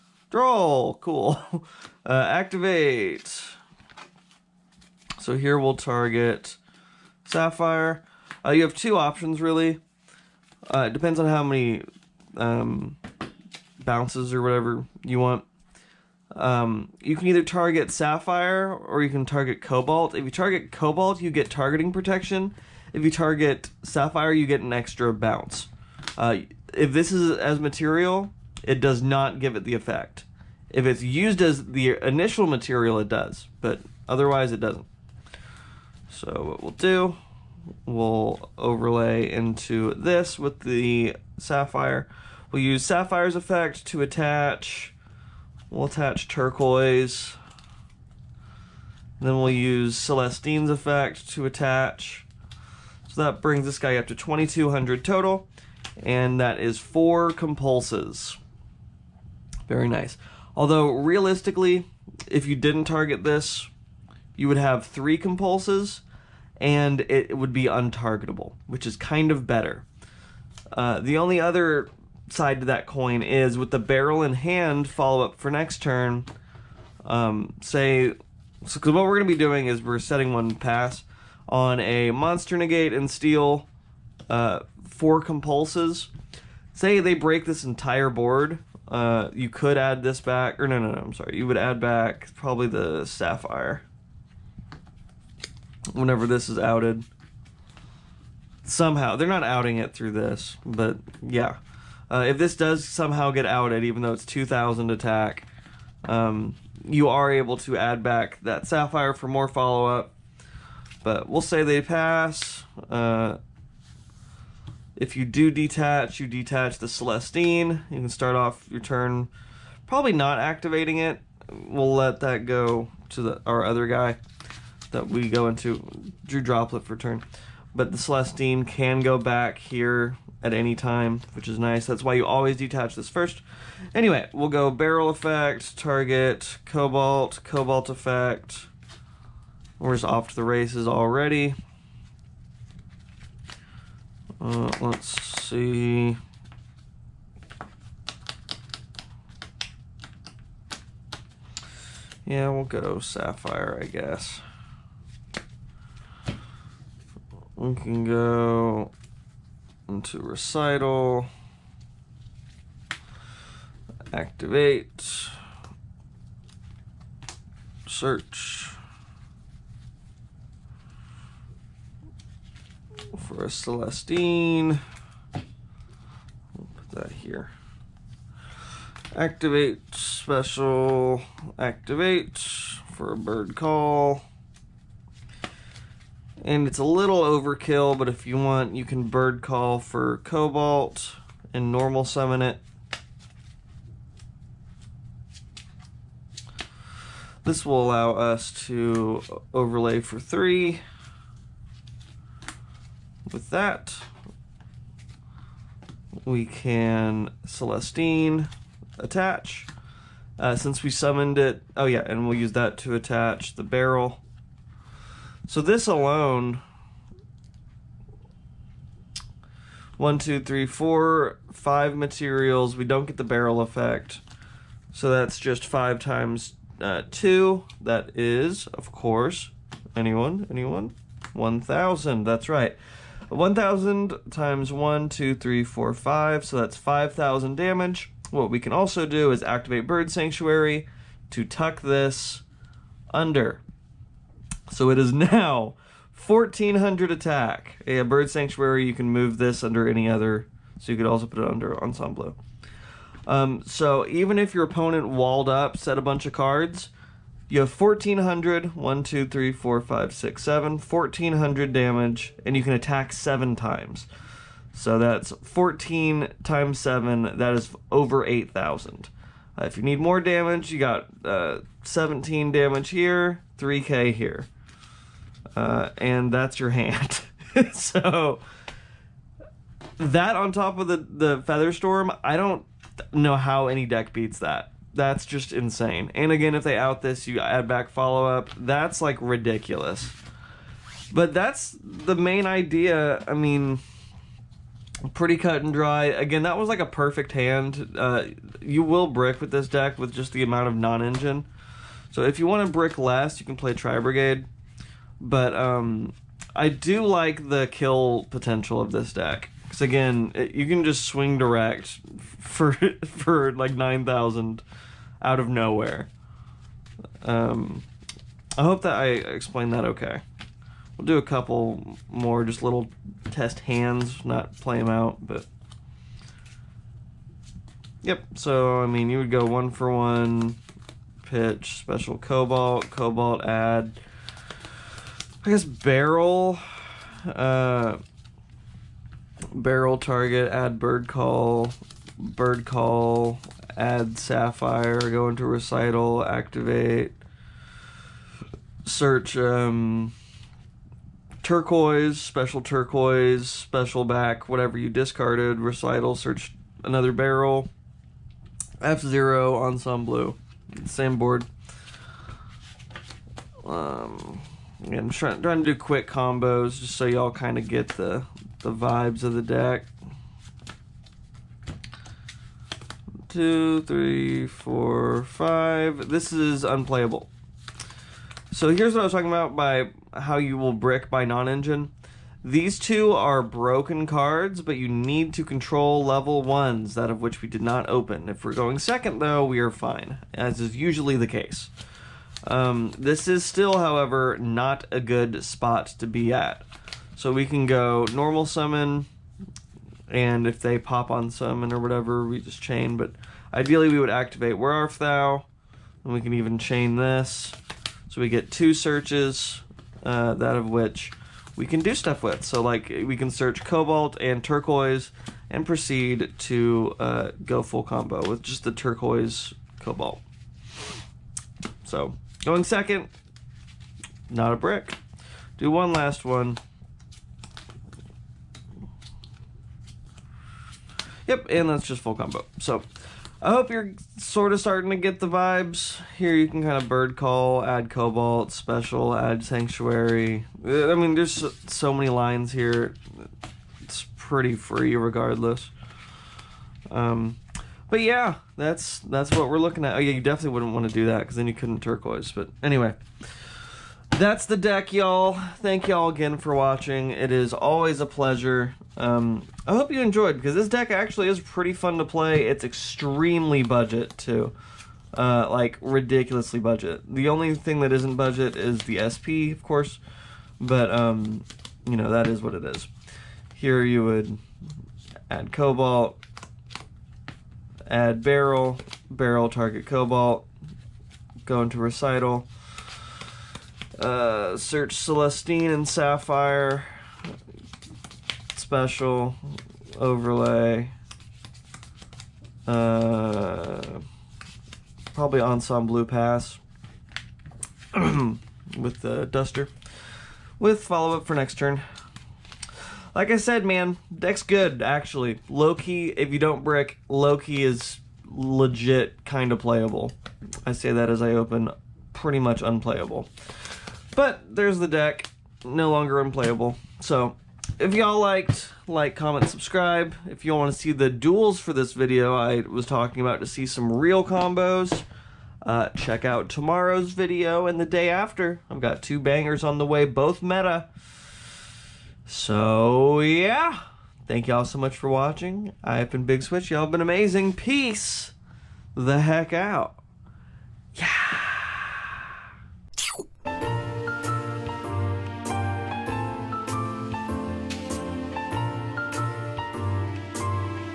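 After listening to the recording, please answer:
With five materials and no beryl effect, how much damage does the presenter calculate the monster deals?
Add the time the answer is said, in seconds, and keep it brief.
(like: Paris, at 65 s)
5,000, at 236 s.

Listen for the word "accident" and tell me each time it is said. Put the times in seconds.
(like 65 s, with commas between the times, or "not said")
not said.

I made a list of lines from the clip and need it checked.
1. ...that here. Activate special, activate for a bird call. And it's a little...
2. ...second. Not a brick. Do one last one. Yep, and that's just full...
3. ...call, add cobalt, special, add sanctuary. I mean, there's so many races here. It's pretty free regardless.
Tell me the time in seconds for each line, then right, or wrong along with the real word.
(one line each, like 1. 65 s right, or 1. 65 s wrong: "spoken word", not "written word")
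1. 176 s right
2. 422 s right
3. 437 s wrong: "lines", not "races".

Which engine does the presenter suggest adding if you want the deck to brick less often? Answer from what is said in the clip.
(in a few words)
Tri Brigade.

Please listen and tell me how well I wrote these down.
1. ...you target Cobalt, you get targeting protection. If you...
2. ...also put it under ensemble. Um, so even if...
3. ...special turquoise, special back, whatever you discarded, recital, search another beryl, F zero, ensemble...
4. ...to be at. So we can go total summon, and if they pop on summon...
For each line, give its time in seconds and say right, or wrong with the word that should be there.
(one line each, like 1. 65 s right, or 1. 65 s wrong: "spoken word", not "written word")
1. 20 s right
2. 251 s right
3. 352 s right
4. 395 s wrong: "normal", not "total".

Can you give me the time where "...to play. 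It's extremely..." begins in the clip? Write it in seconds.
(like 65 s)
461 s.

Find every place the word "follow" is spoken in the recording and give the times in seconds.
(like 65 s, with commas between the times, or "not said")
74 s, 109 s, 287 s, 500 s.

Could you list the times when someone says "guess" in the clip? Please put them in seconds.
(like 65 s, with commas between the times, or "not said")
153 s, 335 s.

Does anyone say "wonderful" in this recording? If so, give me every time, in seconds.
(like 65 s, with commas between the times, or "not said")
not said.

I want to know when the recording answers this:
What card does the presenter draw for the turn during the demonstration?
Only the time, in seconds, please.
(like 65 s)
126 s.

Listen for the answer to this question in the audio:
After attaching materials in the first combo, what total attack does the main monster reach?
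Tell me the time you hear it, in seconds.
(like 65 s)
54 s.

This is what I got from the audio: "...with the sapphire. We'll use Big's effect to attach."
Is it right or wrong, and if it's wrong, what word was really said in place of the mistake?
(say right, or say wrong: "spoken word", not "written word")
wrong: "Sapphire", not "Big".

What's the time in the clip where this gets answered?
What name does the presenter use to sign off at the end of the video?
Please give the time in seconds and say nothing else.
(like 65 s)
535 s.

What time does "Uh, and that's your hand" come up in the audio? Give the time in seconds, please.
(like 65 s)
275 s.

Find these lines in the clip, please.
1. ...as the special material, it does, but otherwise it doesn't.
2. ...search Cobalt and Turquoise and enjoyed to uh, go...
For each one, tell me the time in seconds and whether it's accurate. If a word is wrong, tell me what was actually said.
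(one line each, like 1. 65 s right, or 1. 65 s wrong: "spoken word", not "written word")
1. 31 s wrong: "initial", not "special"
2. 413 s wrong: "proceed", not "enjoyed".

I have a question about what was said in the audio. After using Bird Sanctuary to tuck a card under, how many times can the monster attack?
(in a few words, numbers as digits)
7.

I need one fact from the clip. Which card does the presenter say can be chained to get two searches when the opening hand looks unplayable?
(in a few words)
Where Art Thou.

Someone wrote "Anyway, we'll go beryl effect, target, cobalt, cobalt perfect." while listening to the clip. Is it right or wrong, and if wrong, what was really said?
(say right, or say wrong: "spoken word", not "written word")
wrong: "effect", not "perfect".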